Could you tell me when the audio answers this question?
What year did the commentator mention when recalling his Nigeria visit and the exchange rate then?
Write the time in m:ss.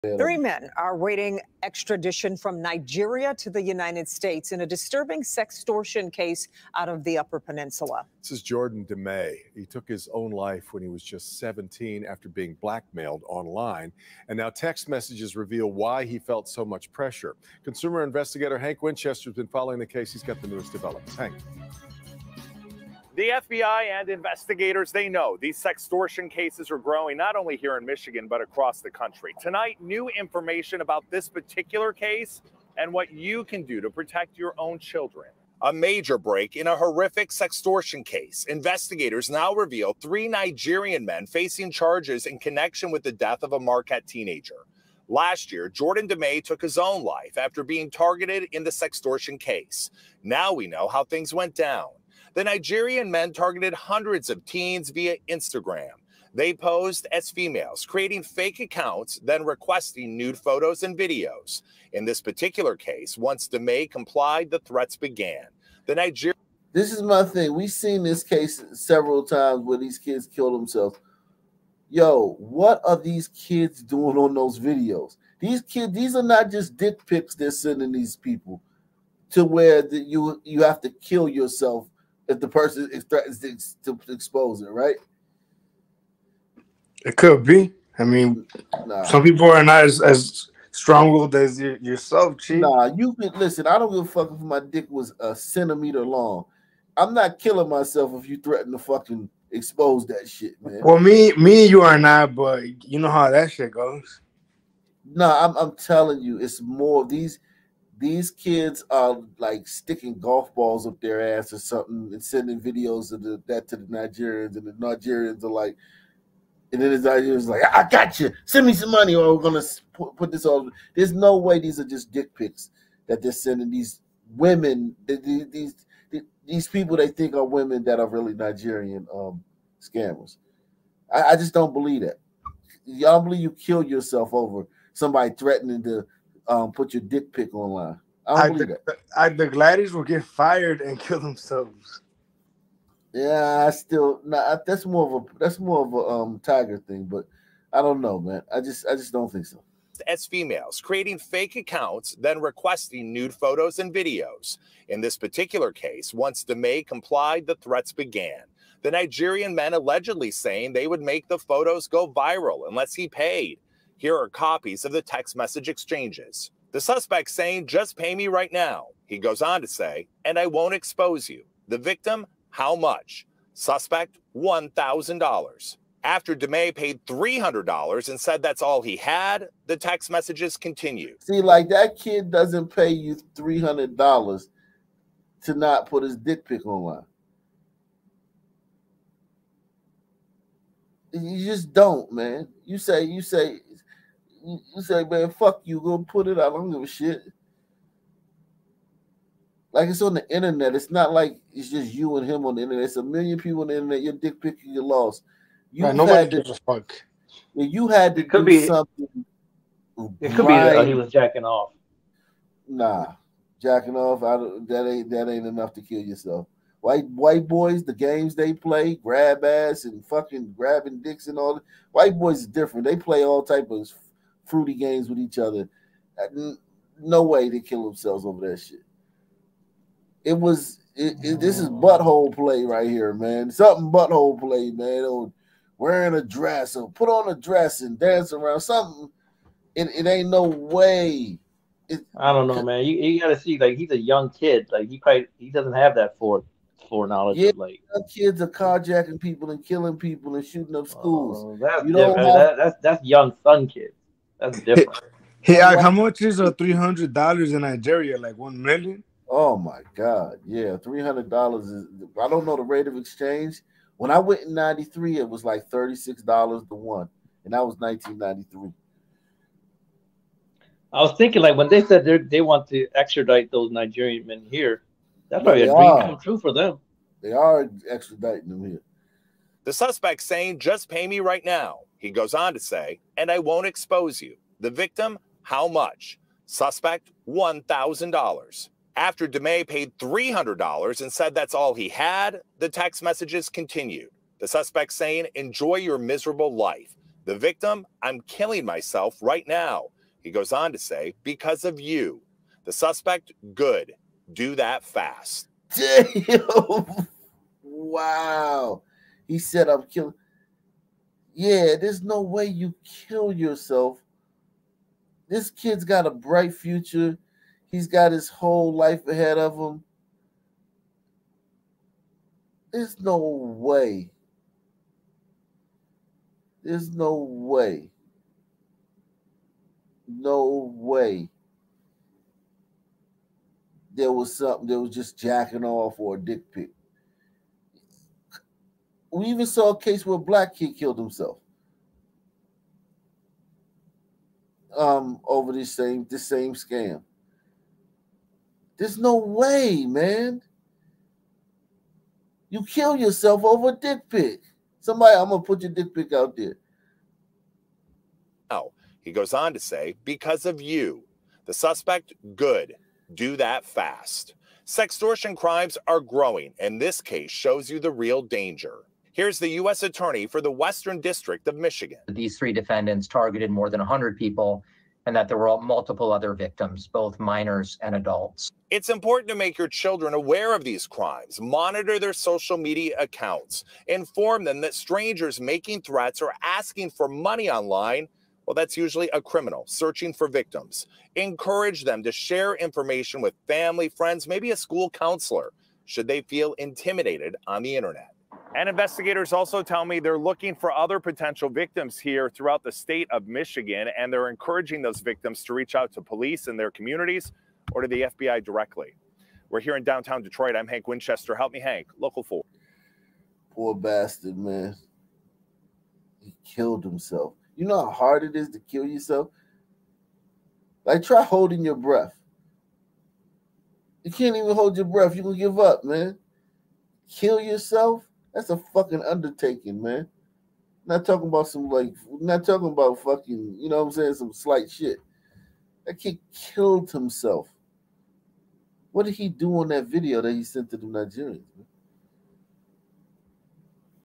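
4:24.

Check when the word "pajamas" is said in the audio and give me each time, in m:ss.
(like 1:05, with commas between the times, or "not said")
not said.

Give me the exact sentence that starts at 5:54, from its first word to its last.
Somebody, I'm gonna put your dick pic out there.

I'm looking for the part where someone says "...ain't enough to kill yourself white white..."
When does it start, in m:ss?
3:35.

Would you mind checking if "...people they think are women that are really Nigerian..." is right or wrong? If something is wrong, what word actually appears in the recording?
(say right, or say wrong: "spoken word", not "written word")
right.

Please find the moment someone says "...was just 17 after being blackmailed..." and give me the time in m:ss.
0:10.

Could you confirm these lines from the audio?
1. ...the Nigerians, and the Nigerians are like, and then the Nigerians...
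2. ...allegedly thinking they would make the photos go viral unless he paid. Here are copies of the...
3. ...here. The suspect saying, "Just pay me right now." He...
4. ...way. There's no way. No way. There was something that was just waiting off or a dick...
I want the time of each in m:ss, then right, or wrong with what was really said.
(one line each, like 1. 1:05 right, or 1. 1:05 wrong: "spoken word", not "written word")
1. 1:53 right
2. 2:39 wrong: "saying", not "thinking"
3. 4:38 right
4. 5:23 wrong: "jacking", not "waiting".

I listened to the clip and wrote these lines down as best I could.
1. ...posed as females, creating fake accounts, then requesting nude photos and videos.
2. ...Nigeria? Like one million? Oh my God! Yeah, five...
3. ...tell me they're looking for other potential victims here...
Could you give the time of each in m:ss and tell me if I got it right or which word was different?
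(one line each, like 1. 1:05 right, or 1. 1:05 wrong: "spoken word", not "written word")
1. 0:56 right
2. 4:17 wrong: "three", not "five"
3. 6:39 right.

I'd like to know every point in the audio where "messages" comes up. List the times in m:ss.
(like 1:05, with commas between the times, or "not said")
0:14, 2:45, 3:00, 4:53.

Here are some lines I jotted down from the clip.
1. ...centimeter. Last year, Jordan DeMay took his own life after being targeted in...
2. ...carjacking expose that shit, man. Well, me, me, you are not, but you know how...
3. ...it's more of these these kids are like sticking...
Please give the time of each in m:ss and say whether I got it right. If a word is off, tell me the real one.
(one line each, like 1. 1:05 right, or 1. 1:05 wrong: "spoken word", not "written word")
1. 0:44 wrong: "teenager", not "centimeter"
2. 1:38 wrong: "fucking", not "carjacking"
3. 1:46 right.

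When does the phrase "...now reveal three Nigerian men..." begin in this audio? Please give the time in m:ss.
0:39.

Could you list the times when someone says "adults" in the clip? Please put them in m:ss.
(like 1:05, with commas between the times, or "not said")
6:17.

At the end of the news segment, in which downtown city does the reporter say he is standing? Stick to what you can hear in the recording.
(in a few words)
Detroit.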